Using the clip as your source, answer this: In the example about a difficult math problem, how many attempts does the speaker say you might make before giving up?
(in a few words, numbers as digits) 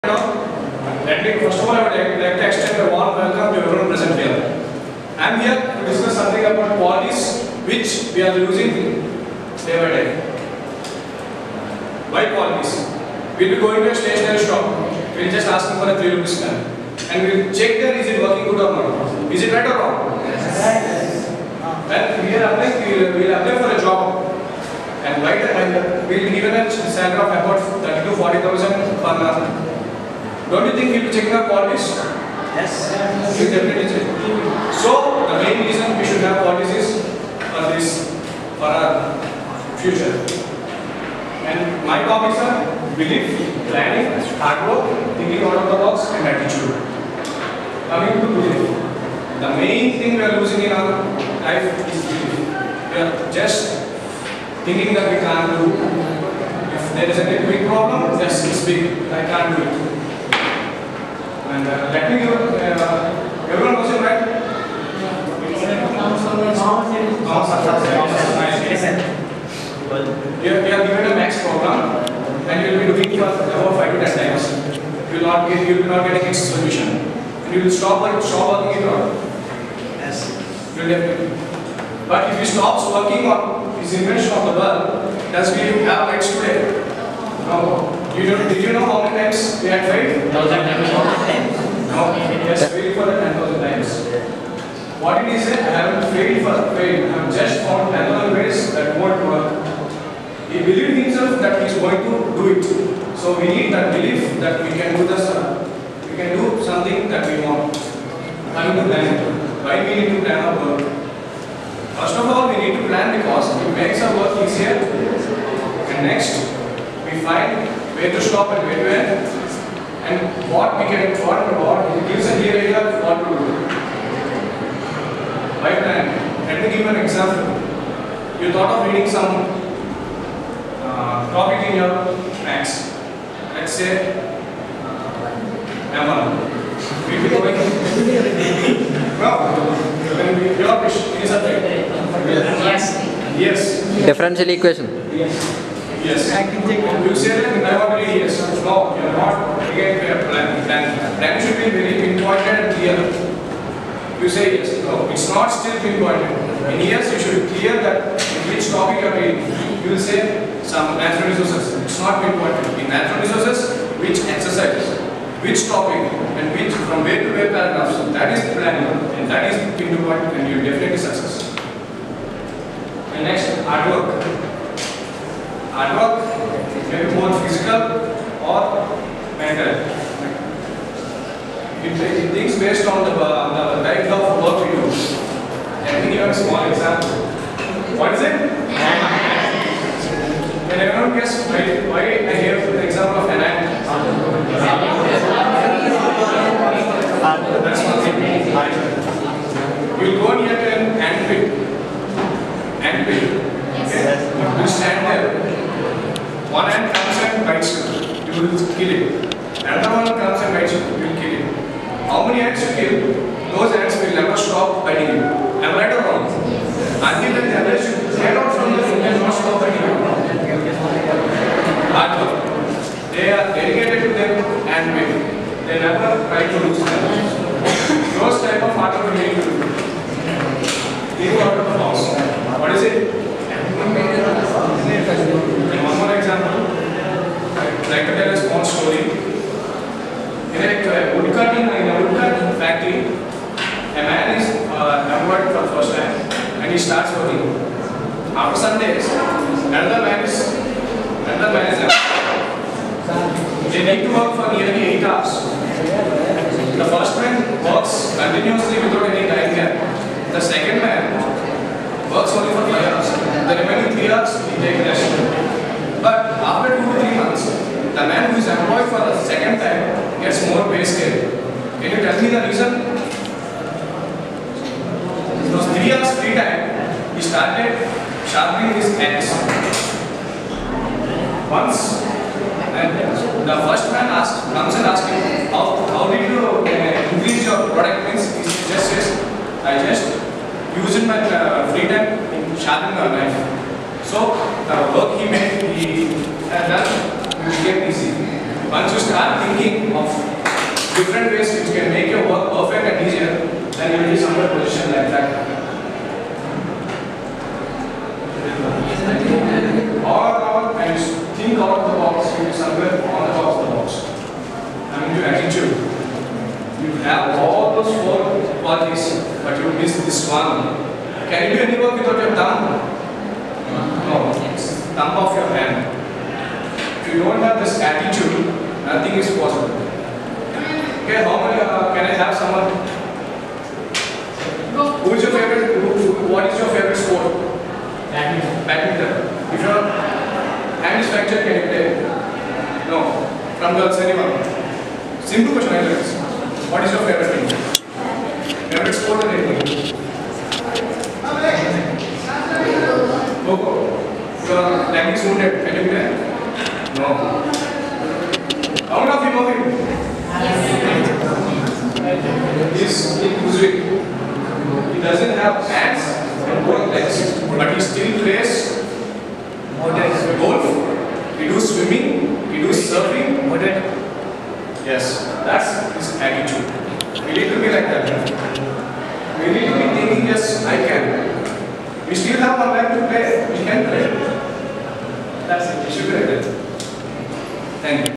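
5 to 10.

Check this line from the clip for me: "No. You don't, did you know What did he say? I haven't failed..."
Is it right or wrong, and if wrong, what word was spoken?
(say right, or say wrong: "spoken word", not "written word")
right.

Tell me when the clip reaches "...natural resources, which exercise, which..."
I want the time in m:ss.
2:42.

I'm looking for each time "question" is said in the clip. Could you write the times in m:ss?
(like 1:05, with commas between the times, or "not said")
1:03, 5:45.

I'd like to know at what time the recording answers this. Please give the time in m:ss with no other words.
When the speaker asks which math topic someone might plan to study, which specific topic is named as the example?
2:24.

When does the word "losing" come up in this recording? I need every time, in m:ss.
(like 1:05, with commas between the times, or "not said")
0:50.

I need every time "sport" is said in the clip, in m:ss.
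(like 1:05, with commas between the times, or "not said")
5:36, 5:48.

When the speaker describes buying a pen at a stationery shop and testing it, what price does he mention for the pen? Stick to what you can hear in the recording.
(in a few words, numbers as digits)
3 rupees.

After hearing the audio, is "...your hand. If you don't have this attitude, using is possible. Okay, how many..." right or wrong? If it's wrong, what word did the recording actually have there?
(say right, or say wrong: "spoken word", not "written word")
wrong: "nothing", not "using".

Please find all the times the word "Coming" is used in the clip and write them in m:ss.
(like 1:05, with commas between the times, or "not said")
0:47, 1:48.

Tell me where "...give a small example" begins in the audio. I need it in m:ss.
3:06.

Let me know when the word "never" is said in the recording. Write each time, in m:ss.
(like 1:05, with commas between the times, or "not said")
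3:34, 3:45.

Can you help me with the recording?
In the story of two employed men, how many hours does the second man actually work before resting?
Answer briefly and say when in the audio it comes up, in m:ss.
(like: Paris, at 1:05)
5, at 4:22.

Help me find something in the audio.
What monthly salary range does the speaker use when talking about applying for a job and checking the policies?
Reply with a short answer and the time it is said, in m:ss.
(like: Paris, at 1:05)
30 to 40,000, at 0:27.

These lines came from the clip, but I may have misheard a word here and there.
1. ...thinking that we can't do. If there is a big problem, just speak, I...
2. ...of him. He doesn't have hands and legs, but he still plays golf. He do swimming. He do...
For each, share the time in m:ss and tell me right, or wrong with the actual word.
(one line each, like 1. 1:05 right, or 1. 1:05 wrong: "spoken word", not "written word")
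1. 0:54 right
2. 5:59 right.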